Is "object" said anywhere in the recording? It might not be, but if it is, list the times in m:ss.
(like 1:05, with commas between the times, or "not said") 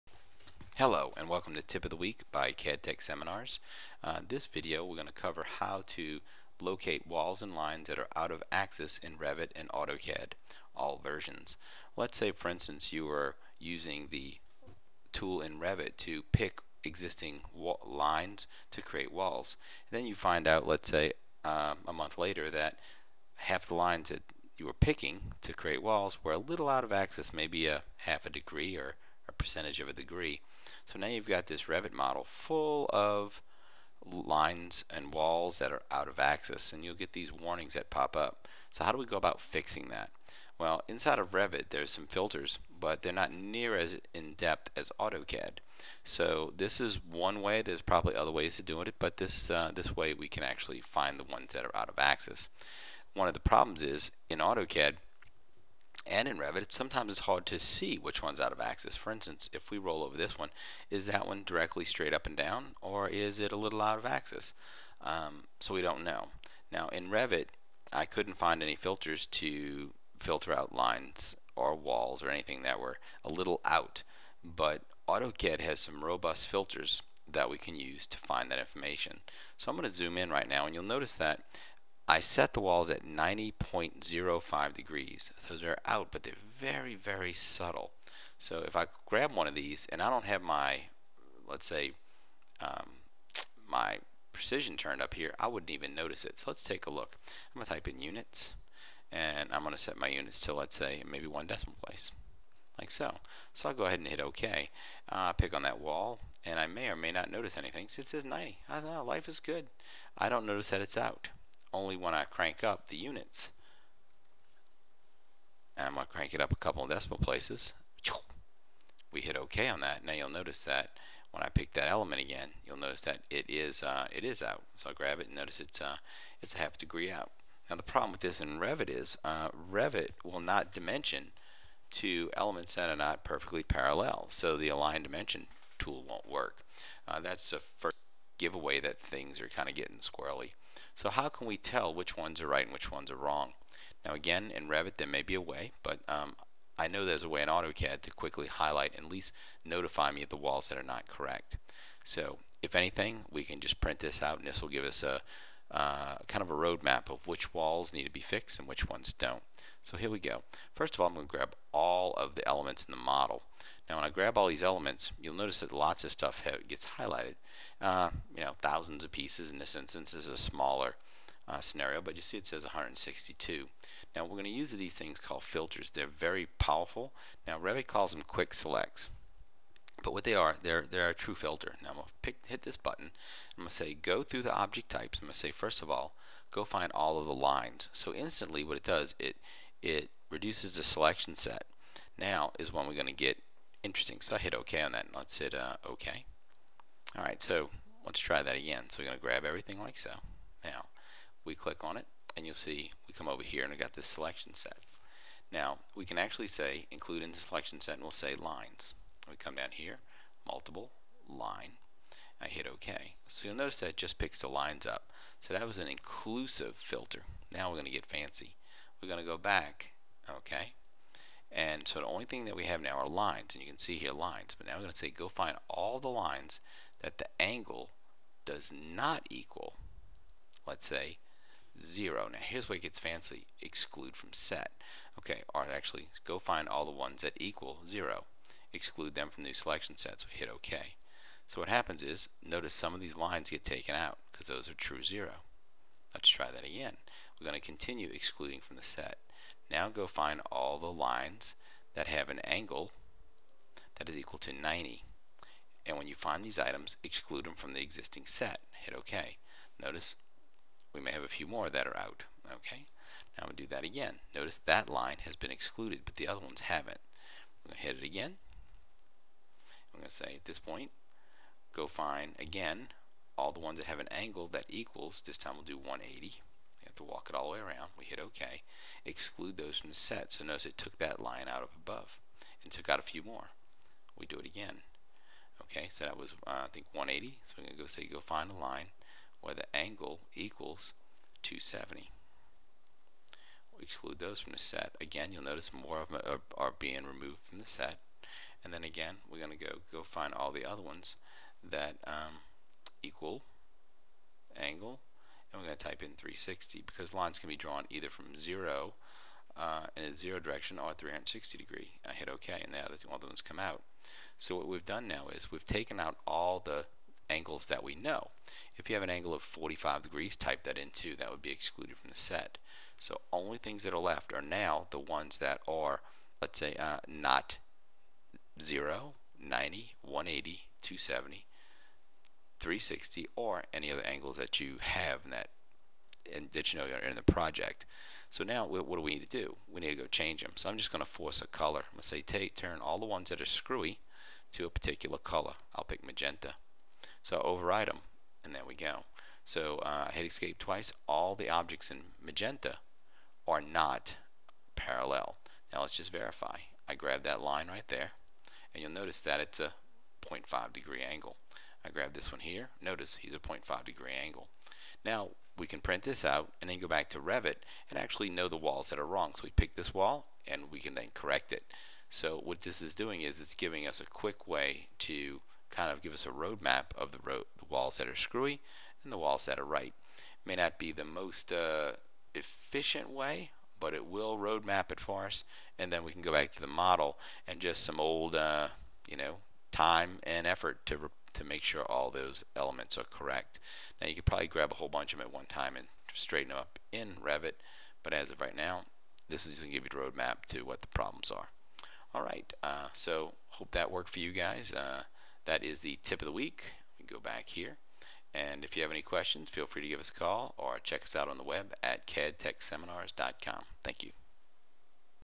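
3:04, 5:51.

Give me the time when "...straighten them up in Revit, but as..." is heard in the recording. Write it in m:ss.
6:36.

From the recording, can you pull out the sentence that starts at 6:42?
All right, uh, so hope that worked for you guys.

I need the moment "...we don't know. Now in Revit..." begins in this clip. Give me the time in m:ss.
1:05.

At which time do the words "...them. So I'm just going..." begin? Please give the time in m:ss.
5:40.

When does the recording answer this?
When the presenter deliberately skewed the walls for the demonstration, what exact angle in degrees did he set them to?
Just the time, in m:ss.
1:23.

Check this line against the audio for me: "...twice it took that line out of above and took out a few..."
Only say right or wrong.
wrong.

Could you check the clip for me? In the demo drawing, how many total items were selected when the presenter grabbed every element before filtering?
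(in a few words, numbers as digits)
162.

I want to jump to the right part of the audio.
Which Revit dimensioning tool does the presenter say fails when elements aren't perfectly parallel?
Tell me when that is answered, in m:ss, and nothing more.
2:14.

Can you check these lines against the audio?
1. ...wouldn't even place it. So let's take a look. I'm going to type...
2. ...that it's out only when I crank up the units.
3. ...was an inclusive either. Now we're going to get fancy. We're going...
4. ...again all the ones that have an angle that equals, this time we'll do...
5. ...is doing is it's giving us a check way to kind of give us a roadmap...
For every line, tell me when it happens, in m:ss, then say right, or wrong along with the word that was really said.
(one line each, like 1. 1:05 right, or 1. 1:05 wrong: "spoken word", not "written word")
1. 1:35 wrong: "notice", not "place"
2. 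1:50 right
3. 3:35 wrong: "filter", not "either"
4. 4:32 right
5. 6:12 wrong: "quick", not "check".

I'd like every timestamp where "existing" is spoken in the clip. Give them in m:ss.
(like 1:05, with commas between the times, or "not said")
0:16, 4:17.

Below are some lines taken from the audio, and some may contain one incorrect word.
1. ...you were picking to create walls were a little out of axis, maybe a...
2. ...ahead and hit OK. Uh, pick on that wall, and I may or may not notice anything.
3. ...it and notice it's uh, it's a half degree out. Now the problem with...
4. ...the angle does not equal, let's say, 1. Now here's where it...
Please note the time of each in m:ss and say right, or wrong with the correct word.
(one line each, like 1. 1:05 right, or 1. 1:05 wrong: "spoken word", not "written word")
1. 0:24 right
2. 1:43 right
3. 2:05 right
4. 3:47 wrong: "0", not "1".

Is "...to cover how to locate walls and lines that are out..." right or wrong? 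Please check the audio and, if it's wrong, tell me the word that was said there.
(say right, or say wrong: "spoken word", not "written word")
right.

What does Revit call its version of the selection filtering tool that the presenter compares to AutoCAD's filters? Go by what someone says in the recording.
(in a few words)
quick selects.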